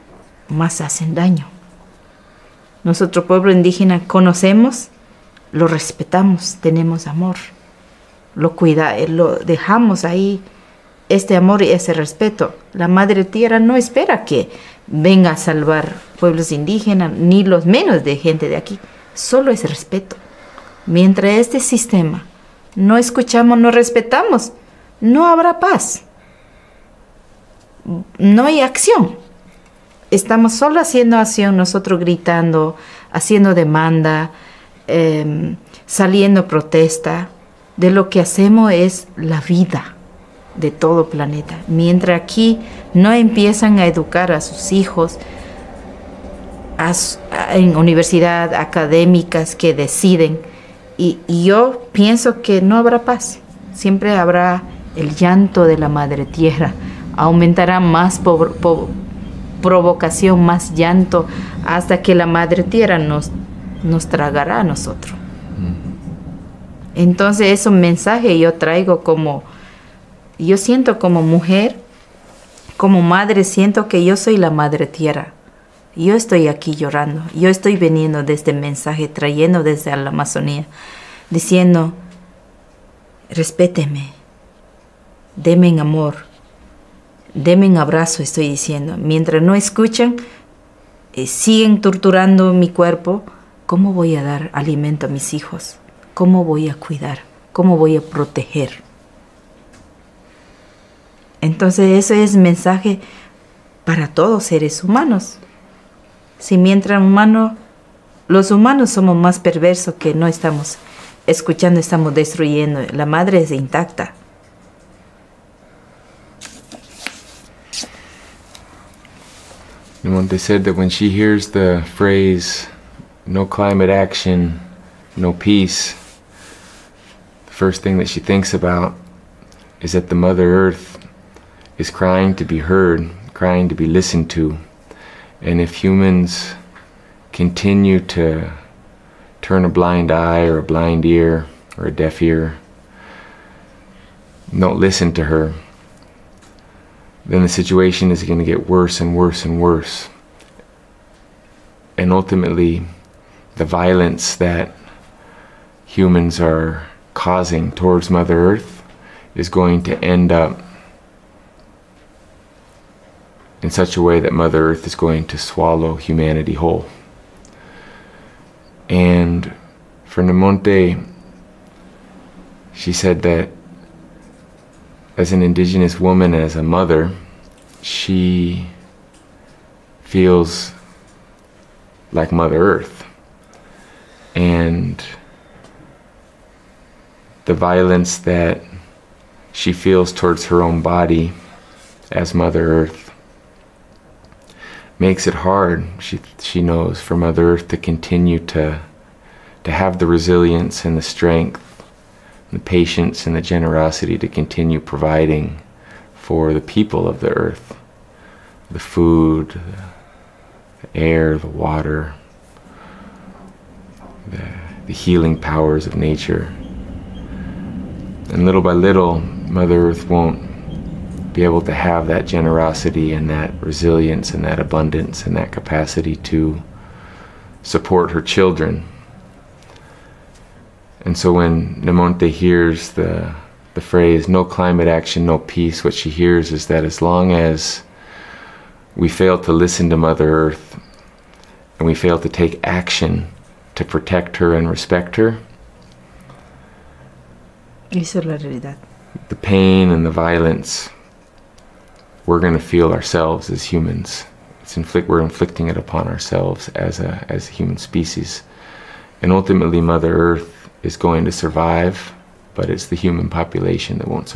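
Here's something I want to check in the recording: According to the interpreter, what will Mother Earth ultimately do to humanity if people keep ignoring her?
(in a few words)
swallow humanity whole.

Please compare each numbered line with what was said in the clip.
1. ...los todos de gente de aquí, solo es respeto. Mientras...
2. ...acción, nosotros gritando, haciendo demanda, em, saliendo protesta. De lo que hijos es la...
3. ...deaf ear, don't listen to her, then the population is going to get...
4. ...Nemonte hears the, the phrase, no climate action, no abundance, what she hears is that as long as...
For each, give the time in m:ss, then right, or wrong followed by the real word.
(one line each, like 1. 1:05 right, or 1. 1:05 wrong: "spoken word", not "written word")
1. 0:17 wrong: "menos", not "todos"
2. 0:31 wrong: "hacemos", not "hijos"
3. 2:21 wrong: "situation", not "population"
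4. 3:51 wrong: "peace", not "abundance".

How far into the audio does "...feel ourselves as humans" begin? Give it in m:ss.
4:12.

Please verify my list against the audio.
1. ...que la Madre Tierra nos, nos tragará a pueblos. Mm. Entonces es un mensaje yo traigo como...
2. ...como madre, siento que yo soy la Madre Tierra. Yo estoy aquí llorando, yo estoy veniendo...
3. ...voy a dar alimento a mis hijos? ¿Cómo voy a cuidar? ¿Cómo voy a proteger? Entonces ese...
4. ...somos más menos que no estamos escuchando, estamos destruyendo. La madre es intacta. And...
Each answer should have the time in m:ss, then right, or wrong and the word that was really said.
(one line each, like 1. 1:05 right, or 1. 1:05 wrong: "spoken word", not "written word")
1. 1:02 wrong: "nosotros", not "pueblos"
2. 1:12 right
3. 1:33 right
4. 1:48 wrong: "perversos", not "menos".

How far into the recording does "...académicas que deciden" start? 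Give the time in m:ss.
0:48.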